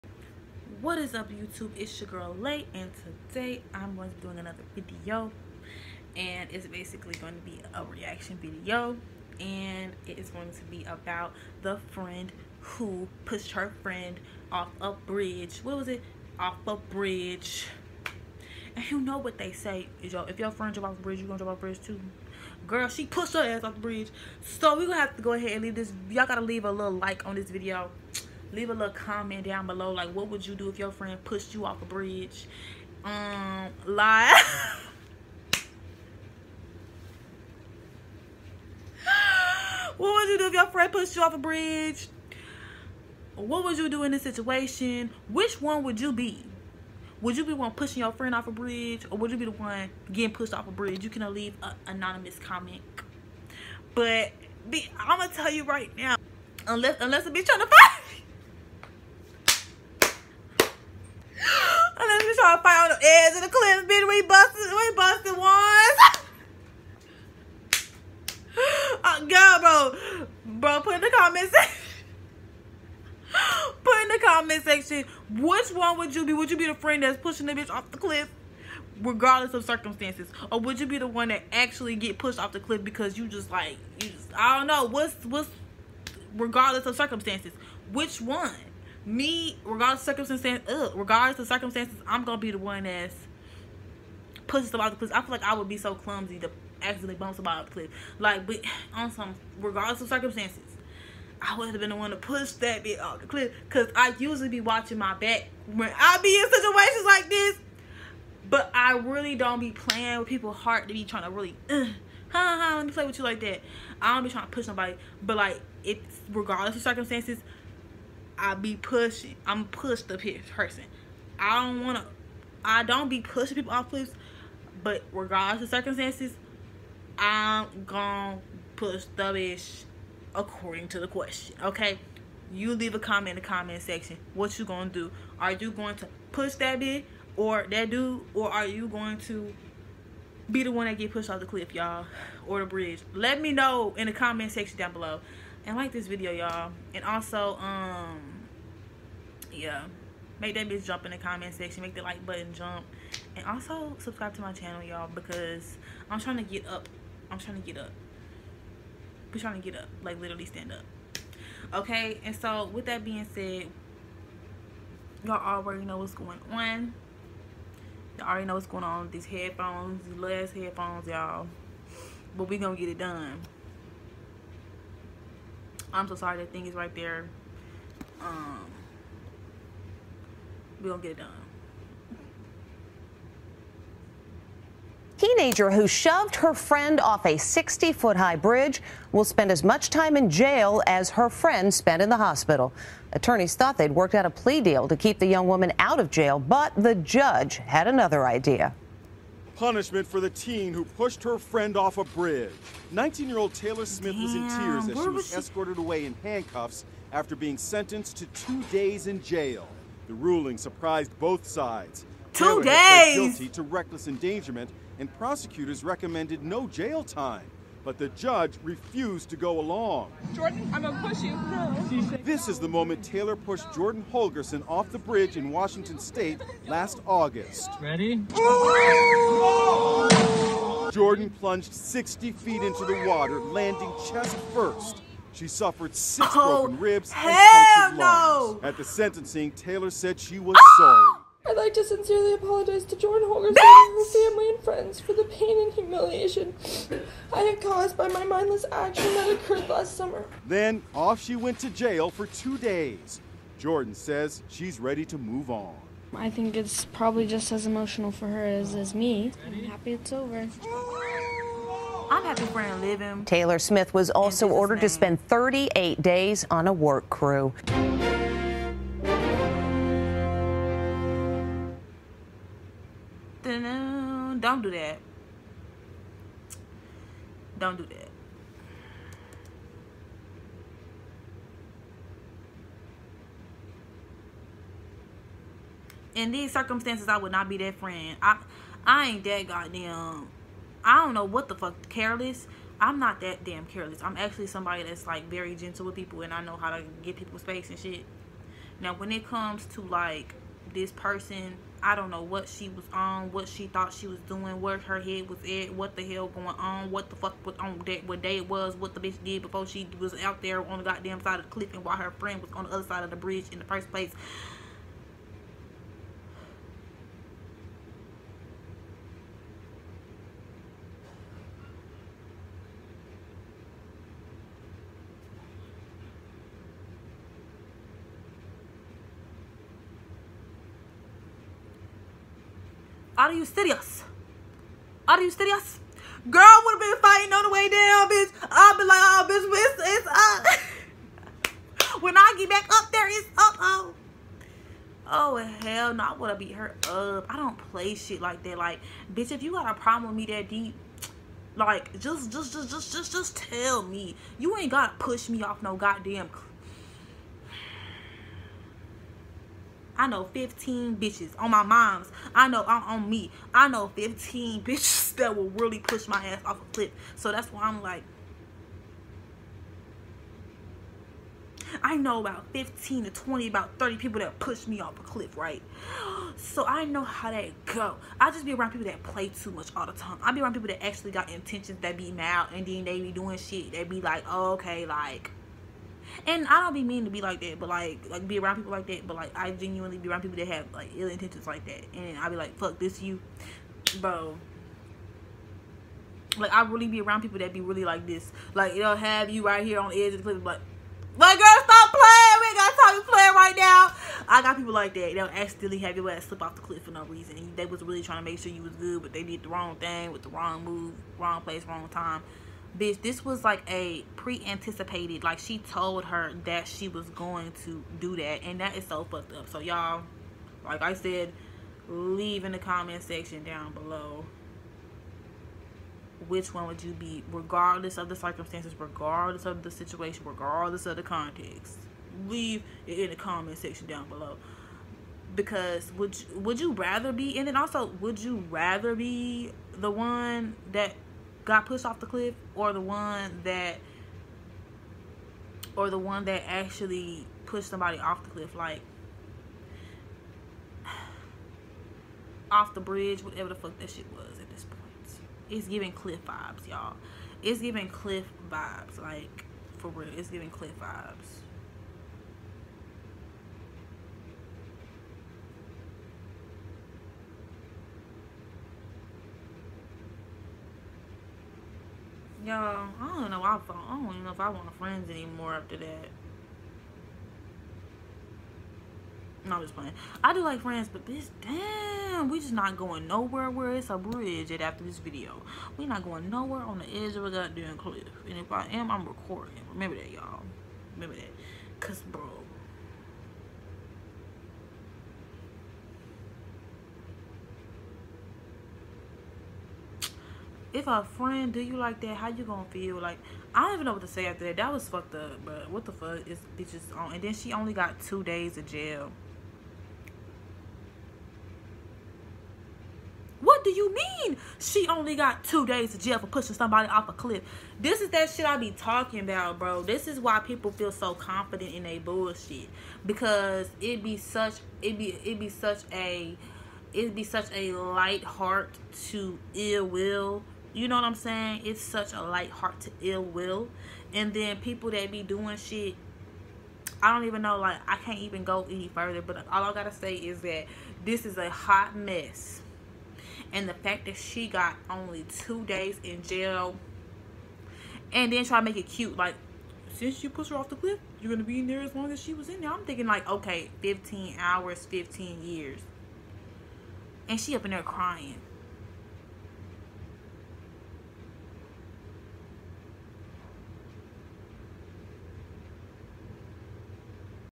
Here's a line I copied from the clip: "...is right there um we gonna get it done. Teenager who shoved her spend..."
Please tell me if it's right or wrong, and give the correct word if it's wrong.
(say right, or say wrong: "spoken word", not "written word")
wrong: "friend", not "spend".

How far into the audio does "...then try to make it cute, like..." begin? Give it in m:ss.
9:08.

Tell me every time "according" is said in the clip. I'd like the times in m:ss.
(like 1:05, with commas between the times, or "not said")
2:10.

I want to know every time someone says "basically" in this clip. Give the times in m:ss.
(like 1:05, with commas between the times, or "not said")
0:06.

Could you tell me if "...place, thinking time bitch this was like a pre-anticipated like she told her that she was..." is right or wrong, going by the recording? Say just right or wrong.
wrong.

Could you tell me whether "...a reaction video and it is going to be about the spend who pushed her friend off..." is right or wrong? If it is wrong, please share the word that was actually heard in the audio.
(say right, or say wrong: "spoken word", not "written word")
wrong: "friend", not "spend".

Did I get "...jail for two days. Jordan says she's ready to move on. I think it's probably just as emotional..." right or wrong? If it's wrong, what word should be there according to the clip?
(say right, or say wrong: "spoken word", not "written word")
right.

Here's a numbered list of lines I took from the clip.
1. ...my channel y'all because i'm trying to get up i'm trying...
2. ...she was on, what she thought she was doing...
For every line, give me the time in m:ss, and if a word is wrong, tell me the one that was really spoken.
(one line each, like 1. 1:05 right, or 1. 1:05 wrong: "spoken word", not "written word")
1. 2:34 right
2. 5:02 right.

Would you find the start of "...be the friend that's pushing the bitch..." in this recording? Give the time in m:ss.
1:16.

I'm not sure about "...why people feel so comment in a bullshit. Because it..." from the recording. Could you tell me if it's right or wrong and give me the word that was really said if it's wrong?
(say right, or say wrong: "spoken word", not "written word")
wrong: "confident", not "comment".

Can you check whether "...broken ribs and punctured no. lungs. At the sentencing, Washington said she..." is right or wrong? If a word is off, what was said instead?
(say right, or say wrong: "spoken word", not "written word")
wrong: "Taylor", not "Washington".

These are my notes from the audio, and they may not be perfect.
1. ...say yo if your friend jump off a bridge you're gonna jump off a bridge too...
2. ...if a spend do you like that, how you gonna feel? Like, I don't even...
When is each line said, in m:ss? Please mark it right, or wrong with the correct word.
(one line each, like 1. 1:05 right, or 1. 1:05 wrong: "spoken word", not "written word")
1. 0:19 right
2. 8:20 wrong: "friend", not "spend".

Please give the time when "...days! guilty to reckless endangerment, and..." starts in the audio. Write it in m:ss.
3:32.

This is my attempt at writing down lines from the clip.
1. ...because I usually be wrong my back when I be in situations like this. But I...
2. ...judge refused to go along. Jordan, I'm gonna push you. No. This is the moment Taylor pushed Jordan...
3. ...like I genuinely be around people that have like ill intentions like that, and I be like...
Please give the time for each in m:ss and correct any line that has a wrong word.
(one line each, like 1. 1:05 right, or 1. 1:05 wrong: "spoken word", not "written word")
1. 1:43 wrong: "watching", not "wrong"
2. 3:38 right
3. 6:29 right.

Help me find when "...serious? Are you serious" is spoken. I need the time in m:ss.
5:33.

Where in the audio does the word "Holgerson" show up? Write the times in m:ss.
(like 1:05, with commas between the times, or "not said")
3:44, 4:03.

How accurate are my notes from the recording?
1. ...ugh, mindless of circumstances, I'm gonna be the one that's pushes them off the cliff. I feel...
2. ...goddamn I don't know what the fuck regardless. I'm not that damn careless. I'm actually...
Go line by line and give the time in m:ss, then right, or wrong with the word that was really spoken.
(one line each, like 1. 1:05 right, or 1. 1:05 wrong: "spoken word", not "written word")
1. 1:30 wrong: "regardless", not "mindless"
2. 4:49 wrong: "careless", not "regardless".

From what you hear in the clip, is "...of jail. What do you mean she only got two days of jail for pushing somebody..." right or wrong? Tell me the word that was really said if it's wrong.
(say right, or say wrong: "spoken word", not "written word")
right.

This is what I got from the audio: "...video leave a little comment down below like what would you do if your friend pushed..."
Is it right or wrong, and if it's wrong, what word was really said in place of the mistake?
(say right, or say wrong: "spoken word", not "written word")
right.